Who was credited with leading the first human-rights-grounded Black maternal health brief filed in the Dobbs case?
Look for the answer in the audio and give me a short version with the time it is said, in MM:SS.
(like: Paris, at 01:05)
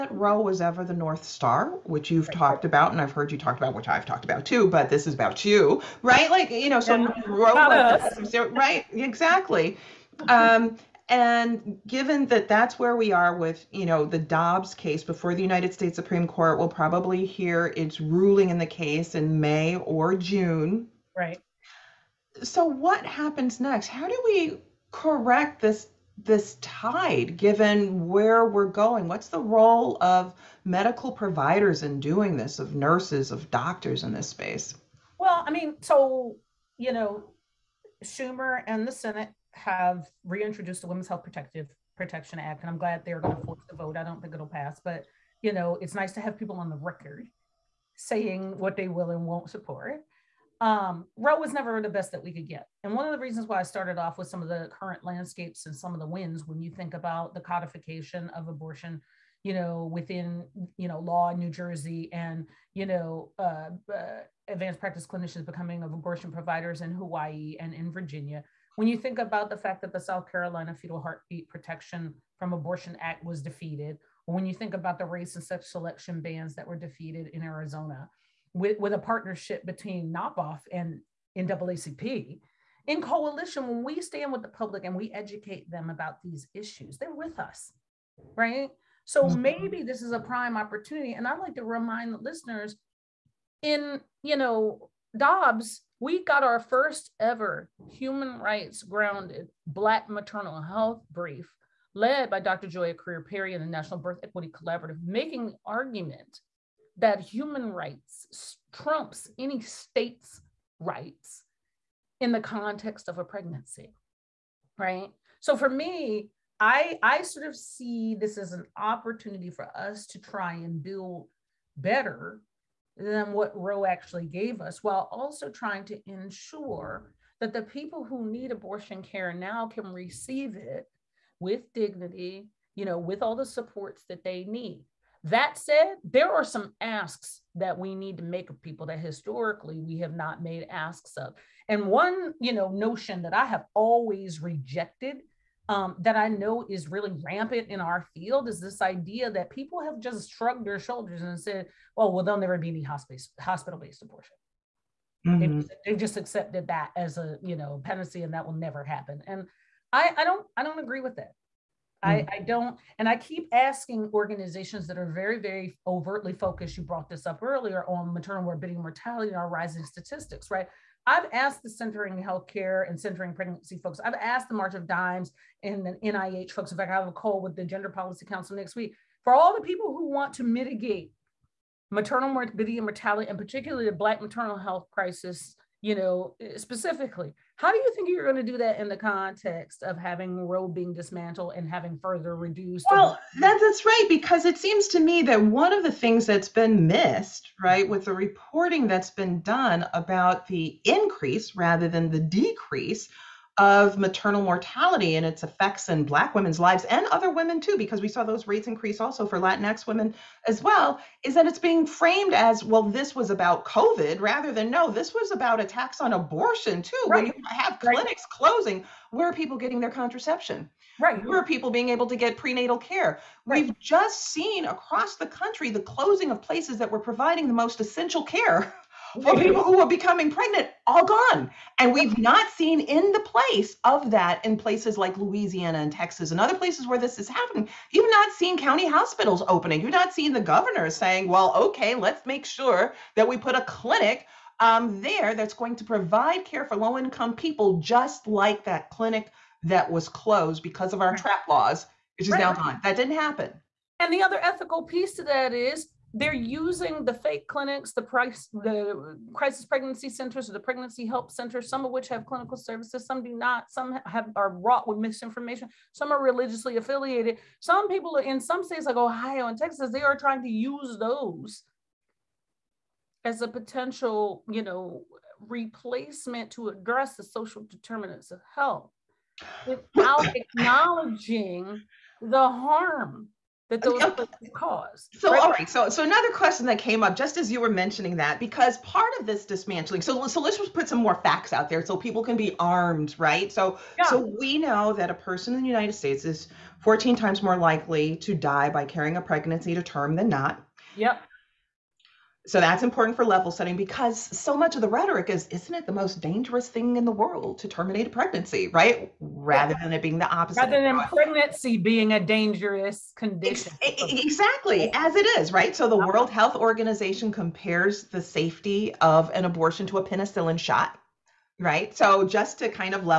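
Dr Joia Crear-Perry, at 01:42.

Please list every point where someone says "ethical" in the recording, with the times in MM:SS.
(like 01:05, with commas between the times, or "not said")
04:14.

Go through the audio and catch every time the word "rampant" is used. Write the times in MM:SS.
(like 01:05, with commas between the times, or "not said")
02:27.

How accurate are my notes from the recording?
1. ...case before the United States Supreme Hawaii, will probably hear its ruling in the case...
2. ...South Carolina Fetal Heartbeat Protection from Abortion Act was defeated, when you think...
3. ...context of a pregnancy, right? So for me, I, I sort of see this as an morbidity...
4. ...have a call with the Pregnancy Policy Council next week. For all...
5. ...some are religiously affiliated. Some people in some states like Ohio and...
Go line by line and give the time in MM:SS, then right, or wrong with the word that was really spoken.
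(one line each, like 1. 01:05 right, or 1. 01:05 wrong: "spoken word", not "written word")
1. 00:14 wrong: "Court", not "Hawaii"
2. 01:09 right
3. 01:52 wrong: "opportunity", not "morbidity"
4. 02:56 wrong: "Gender", not "Pregnancy"
5. 04:25 right.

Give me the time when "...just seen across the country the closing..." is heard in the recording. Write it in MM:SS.
03:43.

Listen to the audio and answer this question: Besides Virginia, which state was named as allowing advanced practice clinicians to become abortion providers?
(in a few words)
Hawaii.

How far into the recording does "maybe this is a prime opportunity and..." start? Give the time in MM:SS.
01:29.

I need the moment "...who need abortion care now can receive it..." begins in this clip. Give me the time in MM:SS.
02:08.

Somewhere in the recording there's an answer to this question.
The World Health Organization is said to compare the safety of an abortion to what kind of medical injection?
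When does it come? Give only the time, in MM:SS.
05:20.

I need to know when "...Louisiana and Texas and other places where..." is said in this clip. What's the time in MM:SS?
03:55.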